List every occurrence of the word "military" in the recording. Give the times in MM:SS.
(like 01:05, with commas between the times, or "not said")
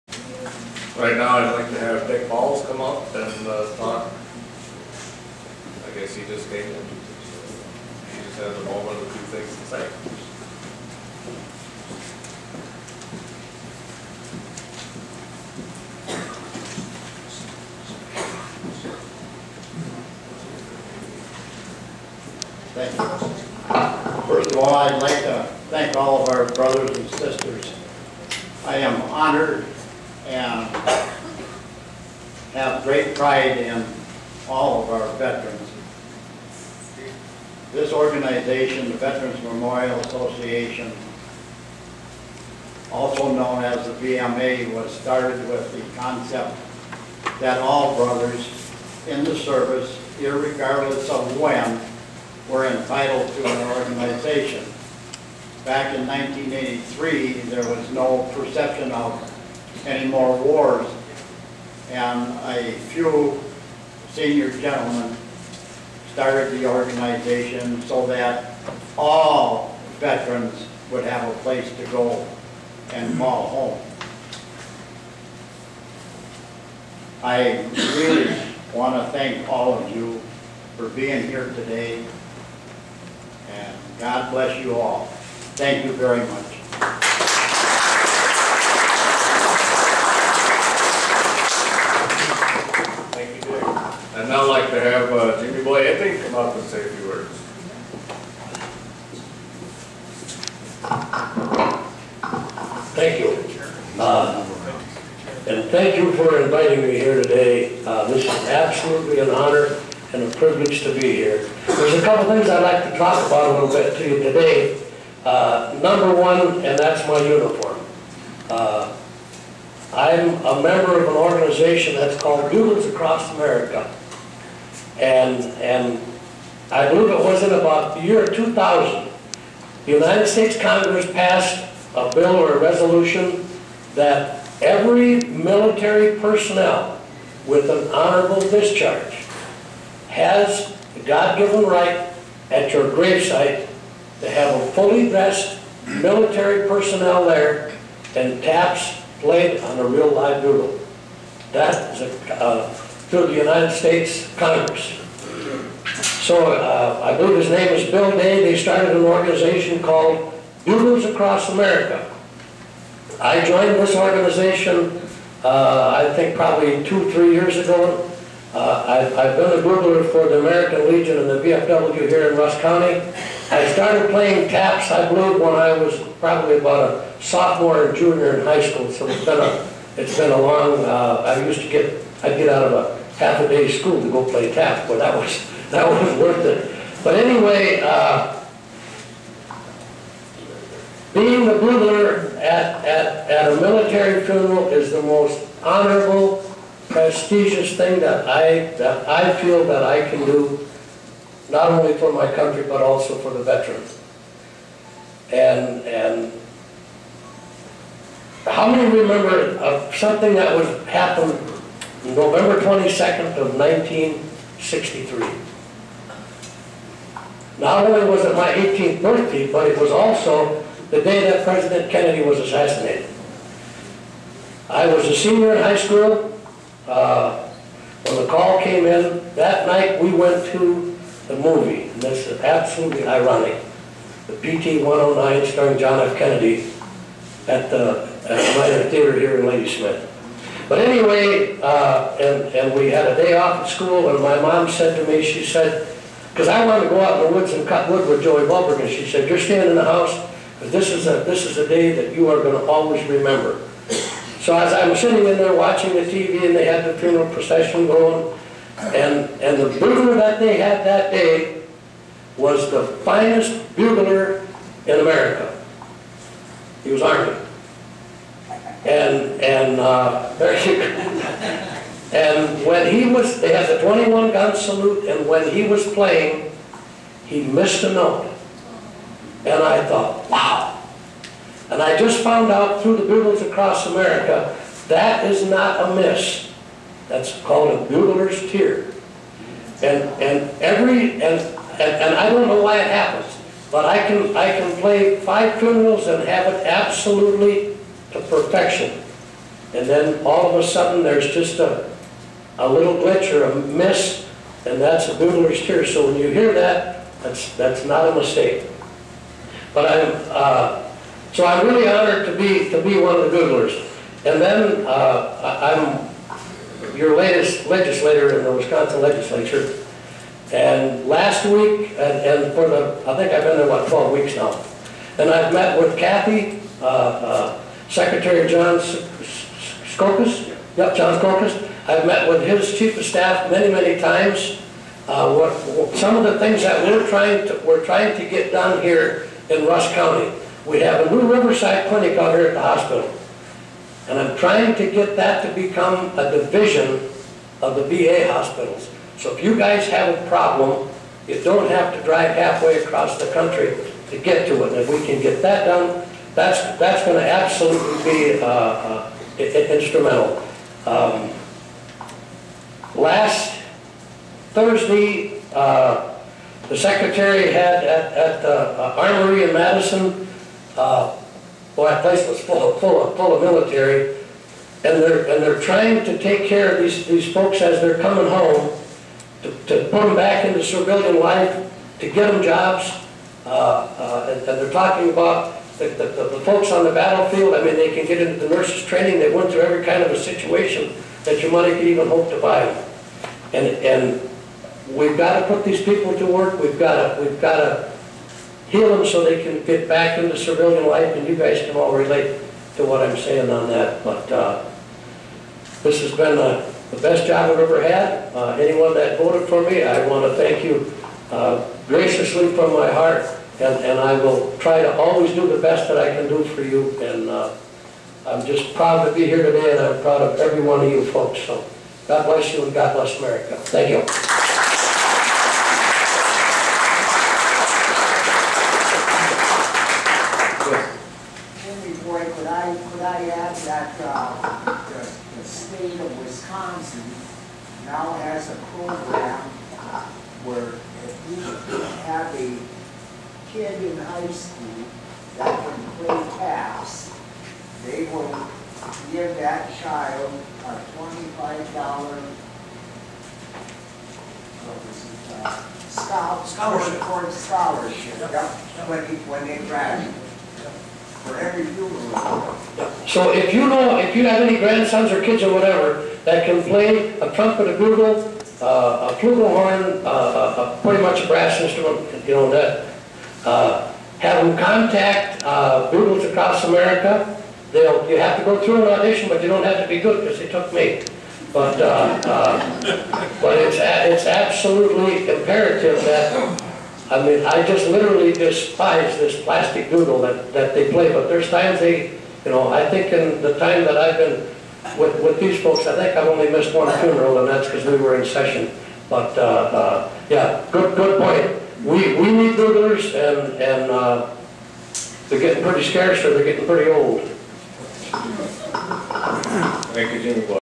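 02:15, 02:25, 03:13, 06:13.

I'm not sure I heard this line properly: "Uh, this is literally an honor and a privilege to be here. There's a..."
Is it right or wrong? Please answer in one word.
wrong.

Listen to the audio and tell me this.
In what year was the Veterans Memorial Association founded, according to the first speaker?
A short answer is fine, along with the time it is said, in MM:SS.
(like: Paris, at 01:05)
1983, at 00:56.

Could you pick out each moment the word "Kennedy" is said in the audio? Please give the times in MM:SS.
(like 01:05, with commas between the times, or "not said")
03:41, 03:56.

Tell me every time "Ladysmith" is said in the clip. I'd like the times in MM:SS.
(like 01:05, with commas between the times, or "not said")
03:59.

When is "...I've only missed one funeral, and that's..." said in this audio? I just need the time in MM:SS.
08:16.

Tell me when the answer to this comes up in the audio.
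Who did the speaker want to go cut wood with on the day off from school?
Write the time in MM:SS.
04:08.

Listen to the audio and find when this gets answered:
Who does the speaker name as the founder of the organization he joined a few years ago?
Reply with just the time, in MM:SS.
02:37.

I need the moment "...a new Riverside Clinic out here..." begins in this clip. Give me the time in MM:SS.
05:41.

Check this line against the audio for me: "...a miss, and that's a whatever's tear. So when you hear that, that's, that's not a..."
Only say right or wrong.
wrong.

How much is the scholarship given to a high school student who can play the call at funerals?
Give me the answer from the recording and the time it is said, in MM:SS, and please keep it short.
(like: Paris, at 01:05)
$25, at 07:30.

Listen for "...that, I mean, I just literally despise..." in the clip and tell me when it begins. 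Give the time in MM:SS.
08:06.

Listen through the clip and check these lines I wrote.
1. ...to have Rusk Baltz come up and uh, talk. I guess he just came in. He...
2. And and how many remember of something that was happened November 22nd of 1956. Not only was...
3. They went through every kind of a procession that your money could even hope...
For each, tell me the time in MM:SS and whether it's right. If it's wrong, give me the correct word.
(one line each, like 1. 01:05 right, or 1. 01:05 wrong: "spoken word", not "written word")
1. 00:01 wrong: "Dick", not "Rusk"
2. 03:25 wrong: "1963", not "1956"
3. 06:29 wrong: "situation", not "procession".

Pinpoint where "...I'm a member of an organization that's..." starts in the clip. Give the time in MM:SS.
01:59.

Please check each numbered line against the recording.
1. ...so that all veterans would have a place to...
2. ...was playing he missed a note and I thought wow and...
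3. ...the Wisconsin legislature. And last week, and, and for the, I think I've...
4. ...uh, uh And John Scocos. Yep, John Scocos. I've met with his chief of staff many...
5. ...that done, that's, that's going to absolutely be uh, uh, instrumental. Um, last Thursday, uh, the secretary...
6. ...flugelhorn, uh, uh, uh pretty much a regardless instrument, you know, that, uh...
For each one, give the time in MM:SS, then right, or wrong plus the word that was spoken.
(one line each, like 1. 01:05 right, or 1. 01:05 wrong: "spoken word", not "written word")
1. 01:07 right
2. 04:35 right
3. 05:18 right
4. 05:26 wrong: "Secretary", not "And"
5. 05:55 right
6. 07:49 wrong: "brass", not "regardless".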